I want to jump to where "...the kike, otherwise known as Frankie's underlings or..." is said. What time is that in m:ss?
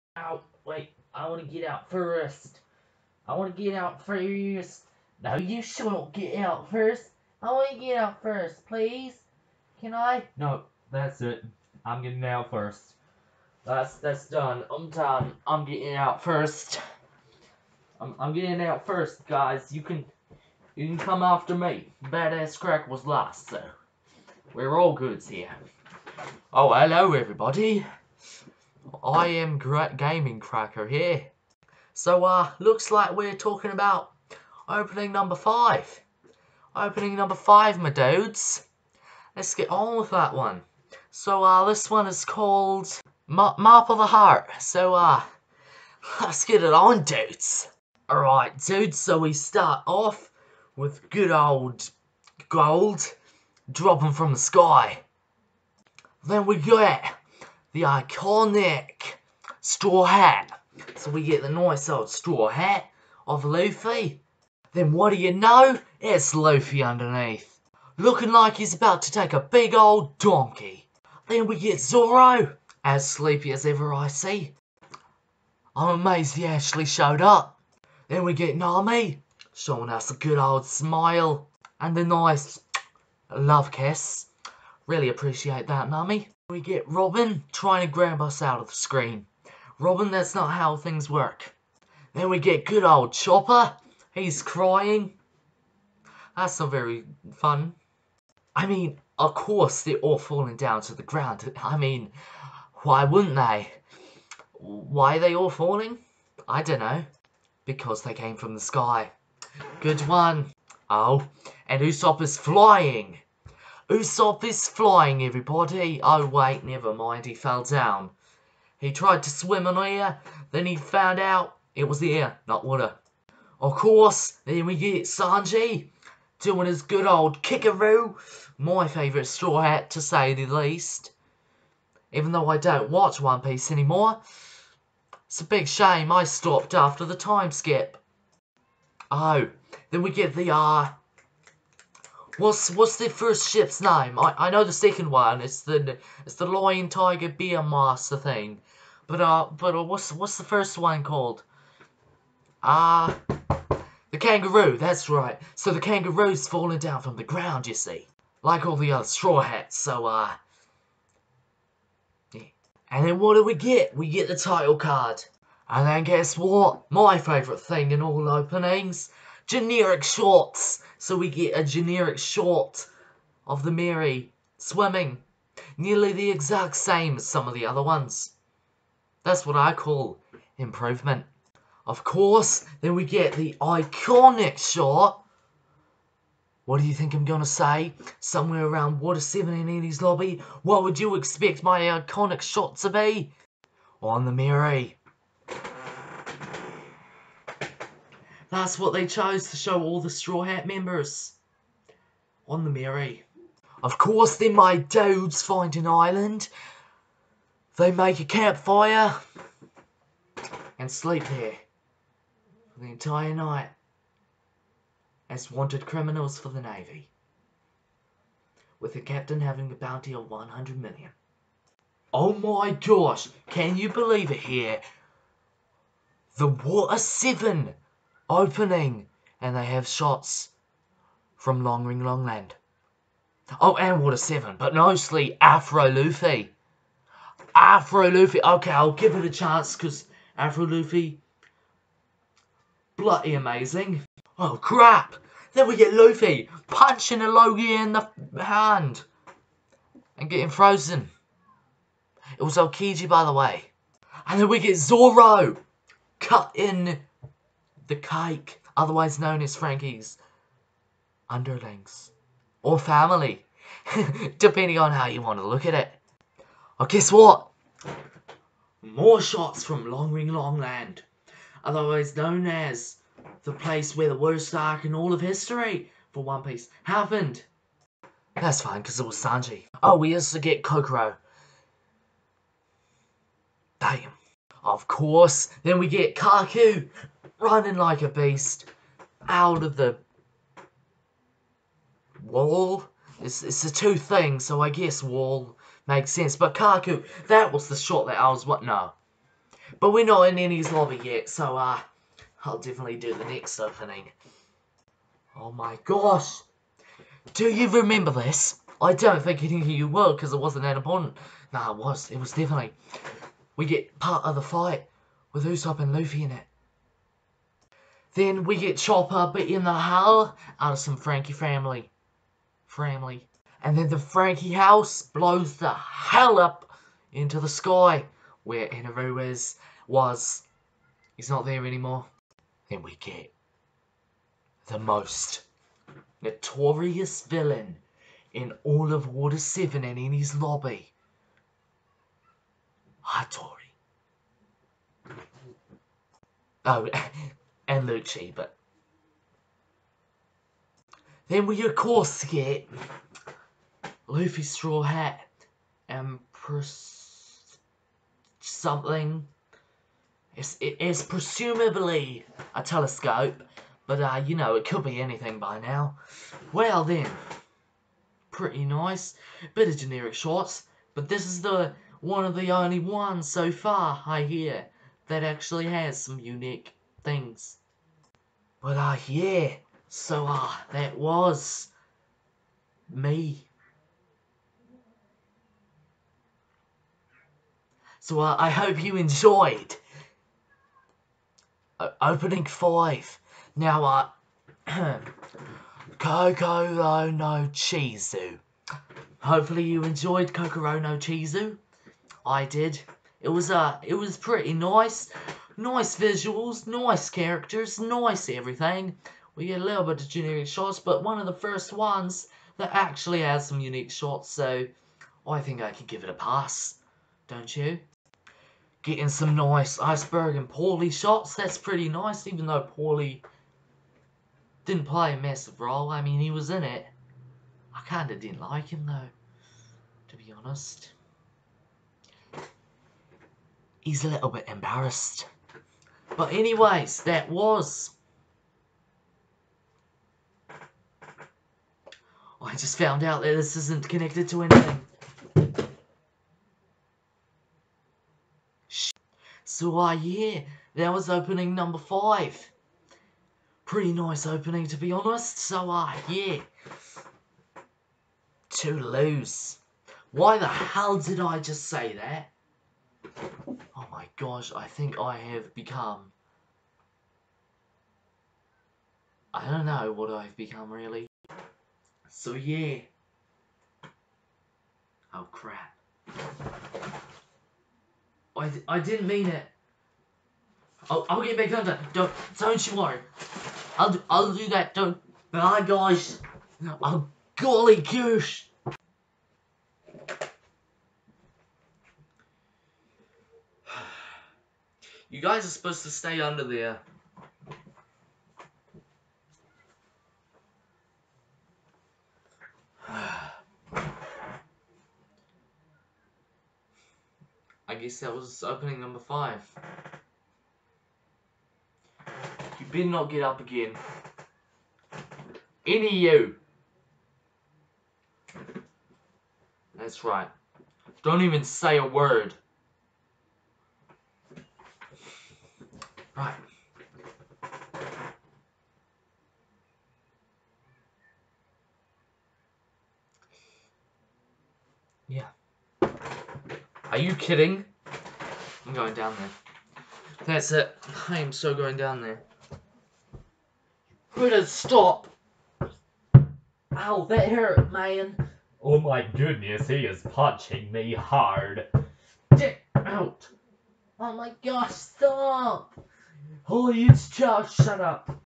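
4:17.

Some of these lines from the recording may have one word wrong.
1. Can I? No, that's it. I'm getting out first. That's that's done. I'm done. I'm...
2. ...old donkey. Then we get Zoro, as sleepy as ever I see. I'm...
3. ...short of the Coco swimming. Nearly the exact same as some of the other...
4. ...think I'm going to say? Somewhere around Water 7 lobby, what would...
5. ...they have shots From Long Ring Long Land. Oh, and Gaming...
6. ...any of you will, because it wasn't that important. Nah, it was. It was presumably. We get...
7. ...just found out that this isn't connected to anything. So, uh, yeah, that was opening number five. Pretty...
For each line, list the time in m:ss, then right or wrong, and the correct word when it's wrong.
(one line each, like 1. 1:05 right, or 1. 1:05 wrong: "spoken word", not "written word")
1. 0:09 right
2. 1:09 right
3. 2:52 wrong: "Merry", not "Coco"
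4. 3:06 right
5. 3:49 wrong: "Water", not "Gaming"
6. 5:09 wrong: "definitely", not "presumably"
7. 7:22 right.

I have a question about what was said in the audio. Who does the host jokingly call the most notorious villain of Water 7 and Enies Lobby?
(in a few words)
Hattori.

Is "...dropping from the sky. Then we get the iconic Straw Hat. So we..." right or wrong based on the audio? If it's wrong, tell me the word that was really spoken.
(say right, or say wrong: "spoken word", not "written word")
right.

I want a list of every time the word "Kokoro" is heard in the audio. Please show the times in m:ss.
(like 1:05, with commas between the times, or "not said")
4:40, 6:40.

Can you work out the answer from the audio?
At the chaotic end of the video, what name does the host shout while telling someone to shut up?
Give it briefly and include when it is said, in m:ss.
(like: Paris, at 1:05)
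Charles, at 9:17.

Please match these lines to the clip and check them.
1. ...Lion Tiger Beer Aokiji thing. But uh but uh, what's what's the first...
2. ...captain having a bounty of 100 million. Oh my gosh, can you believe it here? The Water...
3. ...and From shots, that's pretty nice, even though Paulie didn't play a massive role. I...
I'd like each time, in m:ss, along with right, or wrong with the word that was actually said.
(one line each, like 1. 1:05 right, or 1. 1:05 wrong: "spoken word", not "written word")
1. 2:26 wrong: "Master", not "Aokiji"
2. 3:39 right
3. 7:00 wrong: "Paulie", not "From".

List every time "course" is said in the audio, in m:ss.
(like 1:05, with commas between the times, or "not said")
1:39, 2:03, 3:02, 3:23, 4:44, 5:51.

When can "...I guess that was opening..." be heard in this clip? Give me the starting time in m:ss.
8:27.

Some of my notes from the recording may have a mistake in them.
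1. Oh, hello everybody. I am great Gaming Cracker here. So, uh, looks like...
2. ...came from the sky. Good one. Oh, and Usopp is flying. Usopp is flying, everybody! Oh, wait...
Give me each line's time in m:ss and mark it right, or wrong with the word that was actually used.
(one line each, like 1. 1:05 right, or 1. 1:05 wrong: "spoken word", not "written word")
1. 0:26 right
2. 1:48 right.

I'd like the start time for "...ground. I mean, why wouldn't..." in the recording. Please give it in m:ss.
1:41.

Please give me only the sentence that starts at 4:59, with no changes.
But we're not in Enies Lobby yet, so uh I'll definitely do the next opening.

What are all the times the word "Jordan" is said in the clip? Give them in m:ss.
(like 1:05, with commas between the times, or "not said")
not said.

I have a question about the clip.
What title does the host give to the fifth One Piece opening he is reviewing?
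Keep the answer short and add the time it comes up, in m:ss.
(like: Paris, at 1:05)
Map of the Heart, at 0:43.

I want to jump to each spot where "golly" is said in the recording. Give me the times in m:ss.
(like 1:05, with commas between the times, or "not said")
8:07.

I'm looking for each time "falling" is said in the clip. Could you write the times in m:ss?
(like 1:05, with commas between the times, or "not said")
1:40, 1:45, 2:36.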